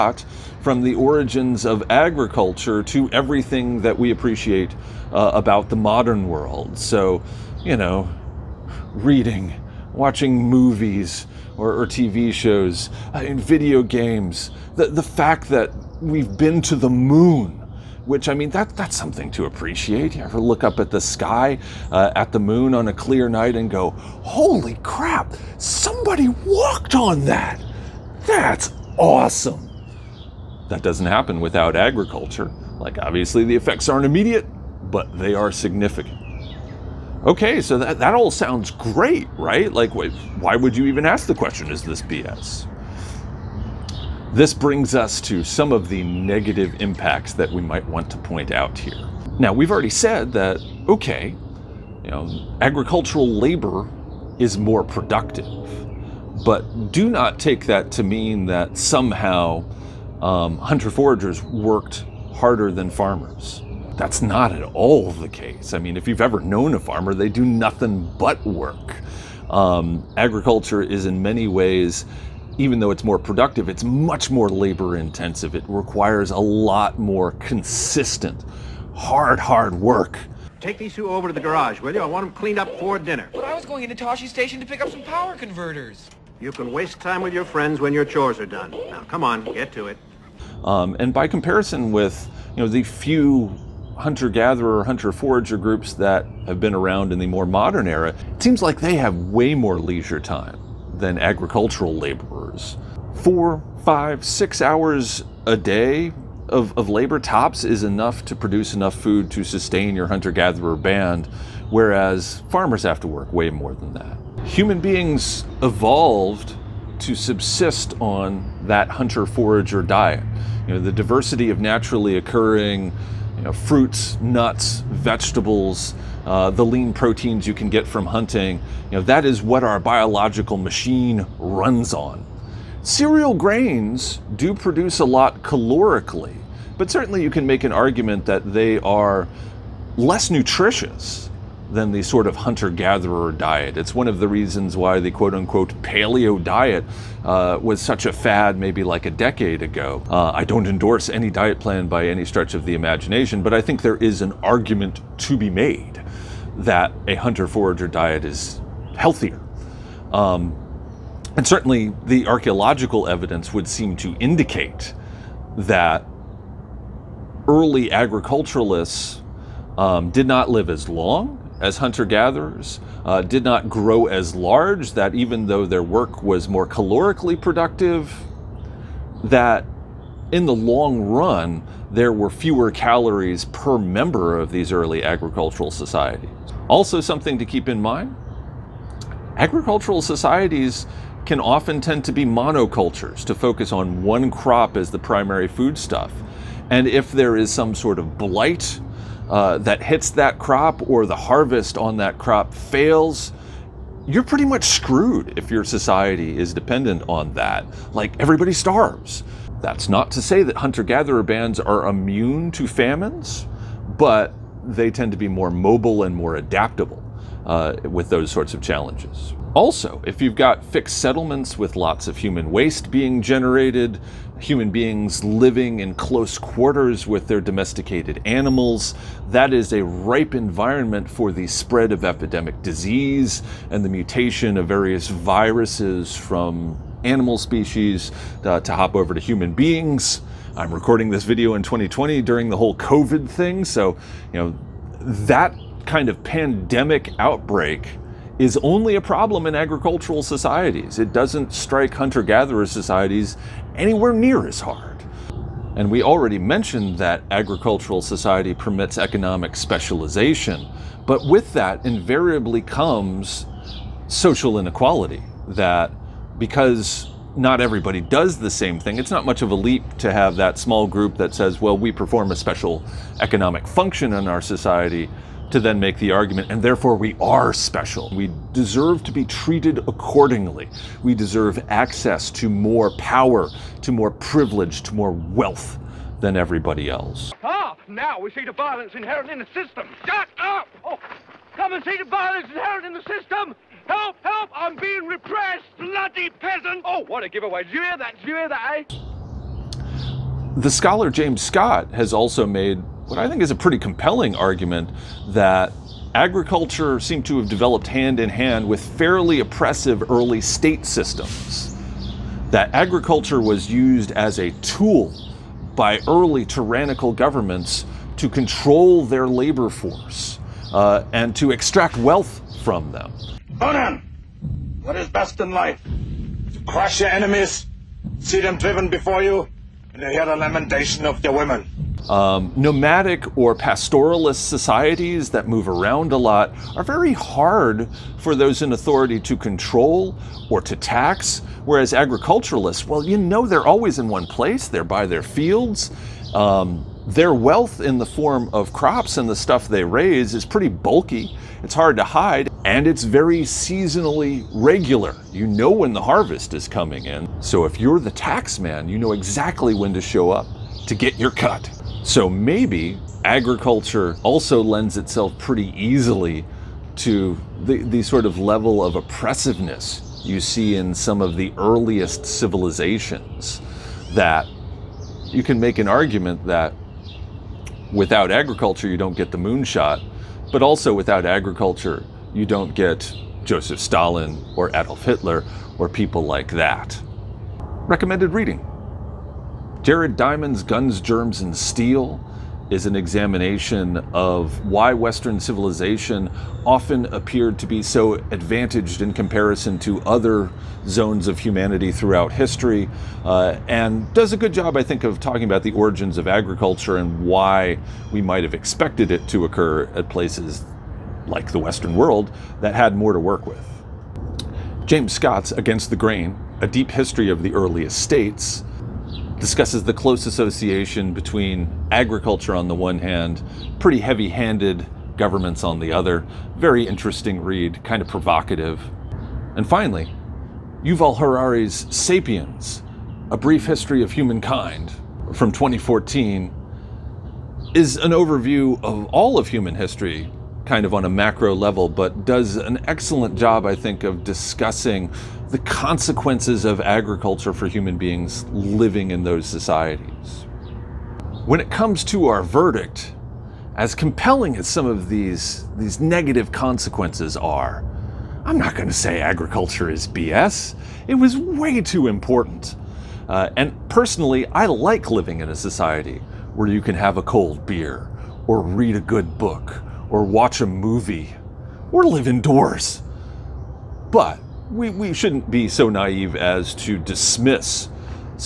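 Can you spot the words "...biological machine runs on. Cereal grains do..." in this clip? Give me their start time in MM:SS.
02:09.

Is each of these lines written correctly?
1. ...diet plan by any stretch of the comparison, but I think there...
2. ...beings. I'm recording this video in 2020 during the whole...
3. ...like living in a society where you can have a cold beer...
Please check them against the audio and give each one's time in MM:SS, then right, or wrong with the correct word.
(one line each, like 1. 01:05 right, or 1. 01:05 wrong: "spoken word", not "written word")
1. 02:31 wrong: "imagination", not "comparison"
2. 03:59 right
3. 07:44 right.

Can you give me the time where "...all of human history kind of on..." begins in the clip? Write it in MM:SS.
07:19.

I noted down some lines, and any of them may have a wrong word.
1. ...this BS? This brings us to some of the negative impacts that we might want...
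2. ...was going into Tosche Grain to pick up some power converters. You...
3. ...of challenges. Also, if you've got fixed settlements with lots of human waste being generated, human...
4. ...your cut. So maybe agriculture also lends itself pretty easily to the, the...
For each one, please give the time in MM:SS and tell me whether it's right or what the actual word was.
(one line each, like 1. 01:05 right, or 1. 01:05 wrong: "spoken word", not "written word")
1. 00:41 right
2. 01:23 wrong: "Station", not "Grain"
3. 03:38 right
4. 06:01 right.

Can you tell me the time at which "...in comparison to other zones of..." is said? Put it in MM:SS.
06:39.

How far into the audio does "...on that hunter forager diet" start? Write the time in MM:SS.
01:57.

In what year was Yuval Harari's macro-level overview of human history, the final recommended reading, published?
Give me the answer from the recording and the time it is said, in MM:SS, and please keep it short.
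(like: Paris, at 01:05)
2014, at 07:15.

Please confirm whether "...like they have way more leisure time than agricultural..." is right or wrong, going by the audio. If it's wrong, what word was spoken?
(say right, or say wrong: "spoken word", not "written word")
right.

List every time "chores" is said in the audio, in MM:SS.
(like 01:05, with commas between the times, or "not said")
01:28.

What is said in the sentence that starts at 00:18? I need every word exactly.
Which I mean, that that's something to appreciate.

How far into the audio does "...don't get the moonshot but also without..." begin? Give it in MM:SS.
06:18.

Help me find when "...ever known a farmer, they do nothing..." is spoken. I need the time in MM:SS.
01:06.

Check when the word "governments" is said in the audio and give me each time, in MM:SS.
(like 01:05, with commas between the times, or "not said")
05:17, 07:05.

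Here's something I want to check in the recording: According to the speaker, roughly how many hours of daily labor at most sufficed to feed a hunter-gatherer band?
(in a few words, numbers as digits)
6 hours.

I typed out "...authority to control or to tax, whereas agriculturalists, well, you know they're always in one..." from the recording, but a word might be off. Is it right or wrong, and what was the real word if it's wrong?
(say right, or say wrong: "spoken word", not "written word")
right.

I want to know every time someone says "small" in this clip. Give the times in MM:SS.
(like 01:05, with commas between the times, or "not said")
04:30.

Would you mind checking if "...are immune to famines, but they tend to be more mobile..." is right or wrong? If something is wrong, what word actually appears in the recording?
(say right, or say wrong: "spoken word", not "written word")
right.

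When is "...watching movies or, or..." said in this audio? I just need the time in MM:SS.
00:09.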